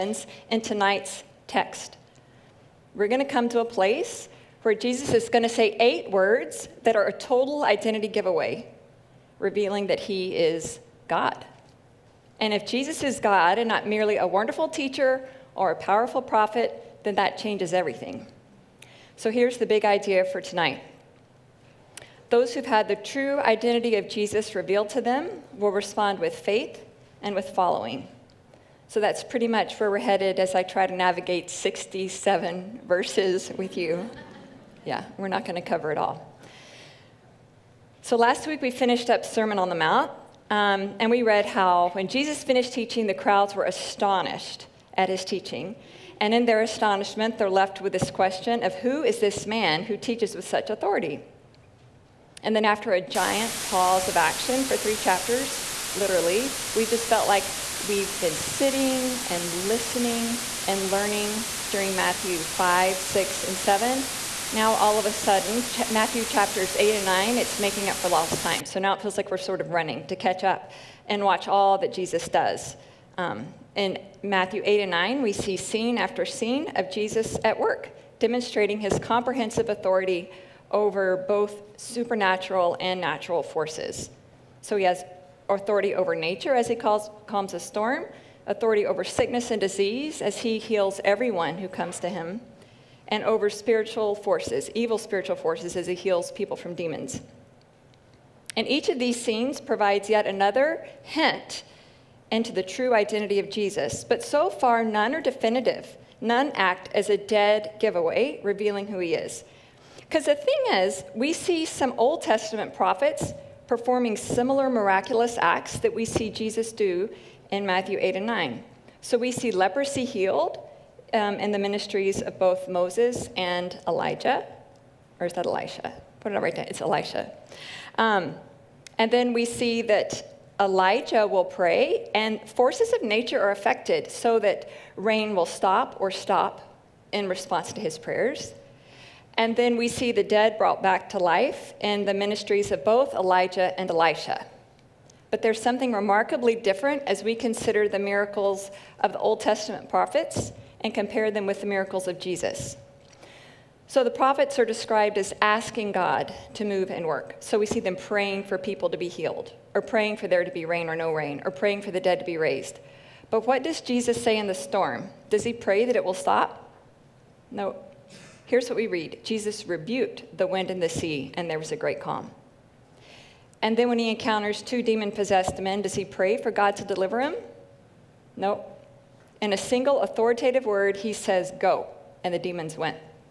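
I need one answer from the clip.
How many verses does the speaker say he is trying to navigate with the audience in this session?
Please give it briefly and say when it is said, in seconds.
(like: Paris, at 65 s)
67, at 31 s.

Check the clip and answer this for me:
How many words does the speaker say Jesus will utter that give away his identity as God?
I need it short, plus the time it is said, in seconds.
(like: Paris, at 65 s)
8, at 5 s.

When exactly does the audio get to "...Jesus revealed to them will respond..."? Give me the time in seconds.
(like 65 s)
24 s.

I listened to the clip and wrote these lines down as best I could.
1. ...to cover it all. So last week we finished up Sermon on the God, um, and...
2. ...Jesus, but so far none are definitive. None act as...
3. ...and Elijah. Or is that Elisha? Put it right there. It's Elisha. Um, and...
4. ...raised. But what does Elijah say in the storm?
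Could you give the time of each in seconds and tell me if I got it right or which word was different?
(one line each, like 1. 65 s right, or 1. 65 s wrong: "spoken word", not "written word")
1. 35 s wrong: "Mount", not "God"
2. 103 s right
3. 123 s right
4. 162 s wrong: "Jesus", not "Elijah".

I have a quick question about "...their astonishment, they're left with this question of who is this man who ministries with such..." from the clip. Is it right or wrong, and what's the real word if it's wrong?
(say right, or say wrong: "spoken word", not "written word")
wrong: "teaches", not "ministries".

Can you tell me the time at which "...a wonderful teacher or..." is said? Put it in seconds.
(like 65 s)
14 s.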